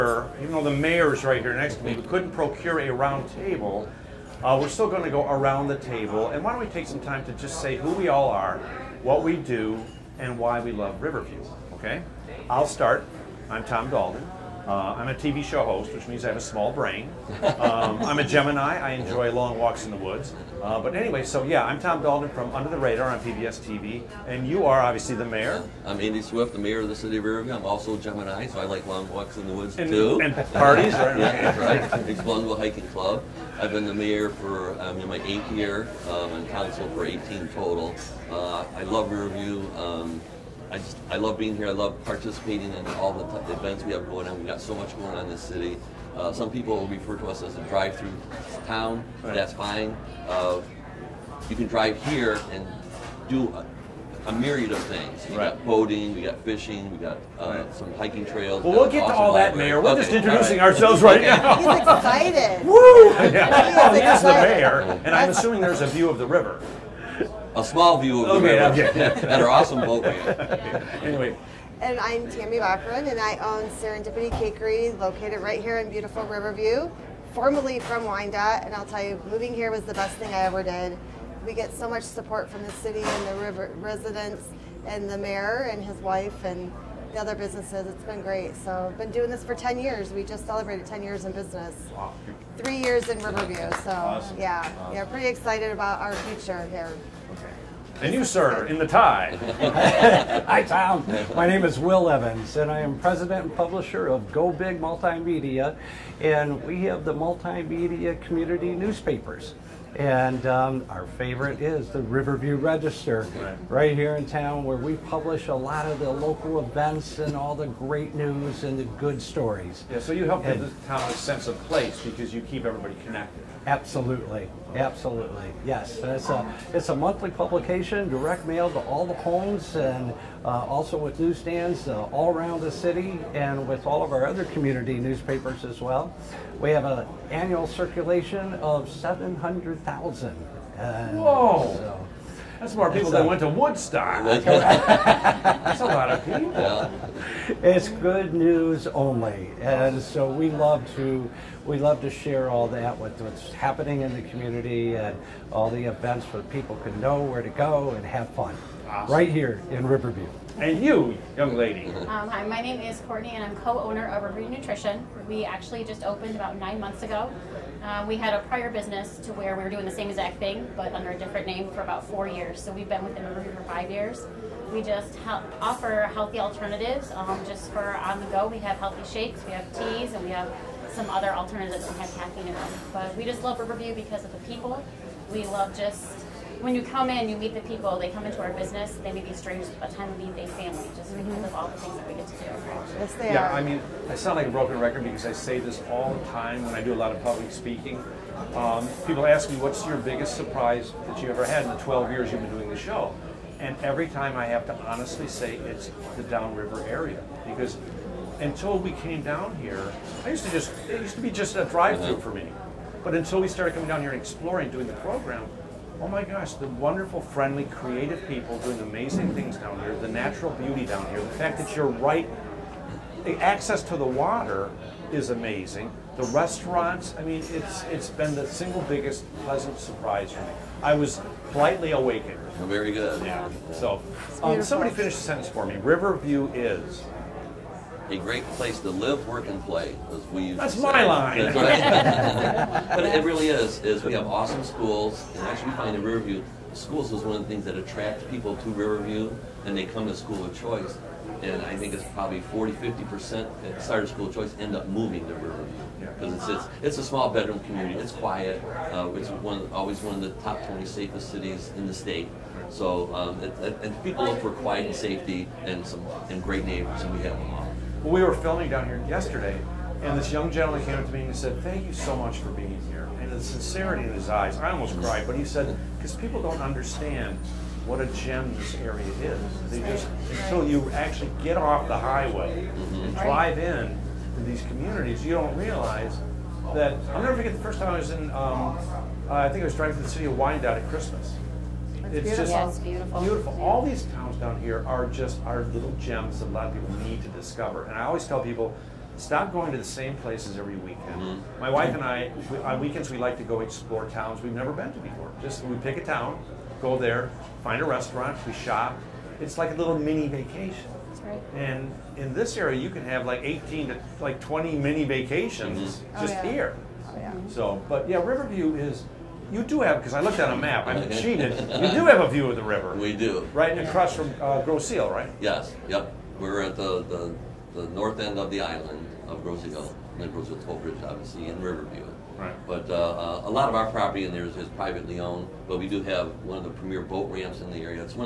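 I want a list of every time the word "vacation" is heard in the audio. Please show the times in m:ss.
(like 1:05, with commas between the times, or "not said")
5:10, 5:15.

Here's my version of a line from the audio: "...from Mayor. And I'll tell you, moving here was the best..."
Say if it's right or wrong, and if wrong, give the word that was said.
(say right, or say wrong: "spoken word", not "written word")
wrong: "Wyandotte", not "Mayor".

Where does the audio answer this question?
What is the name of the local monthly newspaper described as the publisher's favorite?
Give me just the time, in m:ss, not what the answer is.
1:52.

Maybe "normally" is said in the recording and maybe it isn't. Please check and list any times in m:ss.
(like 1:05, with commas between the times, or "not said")
not said.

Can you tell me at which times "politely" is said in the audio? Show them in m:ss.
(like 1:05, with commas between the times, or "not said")
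3:51.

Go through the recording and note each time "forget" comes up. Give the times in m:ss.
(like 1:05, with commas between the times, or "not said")
4:47.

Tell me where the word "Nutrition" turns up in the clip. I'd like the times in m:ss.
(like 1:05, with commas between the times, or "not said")
2:44.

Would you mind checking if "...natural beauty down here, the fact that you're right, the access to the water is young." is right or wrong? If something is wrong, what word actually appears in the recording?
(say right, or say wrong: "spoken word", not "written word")
wrong: "amazing", not "young".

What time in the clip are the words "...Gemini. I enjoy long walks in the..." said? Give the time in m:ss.
0:18.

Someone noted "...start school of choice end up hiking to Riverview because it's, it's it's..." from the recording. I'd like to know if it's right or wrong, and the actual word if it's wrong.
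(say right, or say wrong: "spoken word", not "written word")
wrong: "moving", not "hiking".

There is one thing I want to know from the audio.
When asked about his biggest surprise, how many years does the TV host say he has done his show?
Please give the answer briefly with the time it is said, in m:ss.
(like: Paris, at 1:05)
12, at 3:21.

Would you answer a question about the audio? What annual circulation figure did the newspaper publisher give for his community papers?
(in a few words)
700,000.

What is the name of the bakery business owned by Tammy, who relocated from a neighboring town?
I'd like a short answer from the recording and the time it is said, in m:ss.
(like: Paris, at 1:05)
Serendipity Cakery, at 1:13.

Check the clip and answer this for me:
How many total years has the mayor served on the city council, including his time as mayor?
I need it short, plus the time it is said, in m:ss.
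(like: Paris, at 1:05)
18, at 0:37.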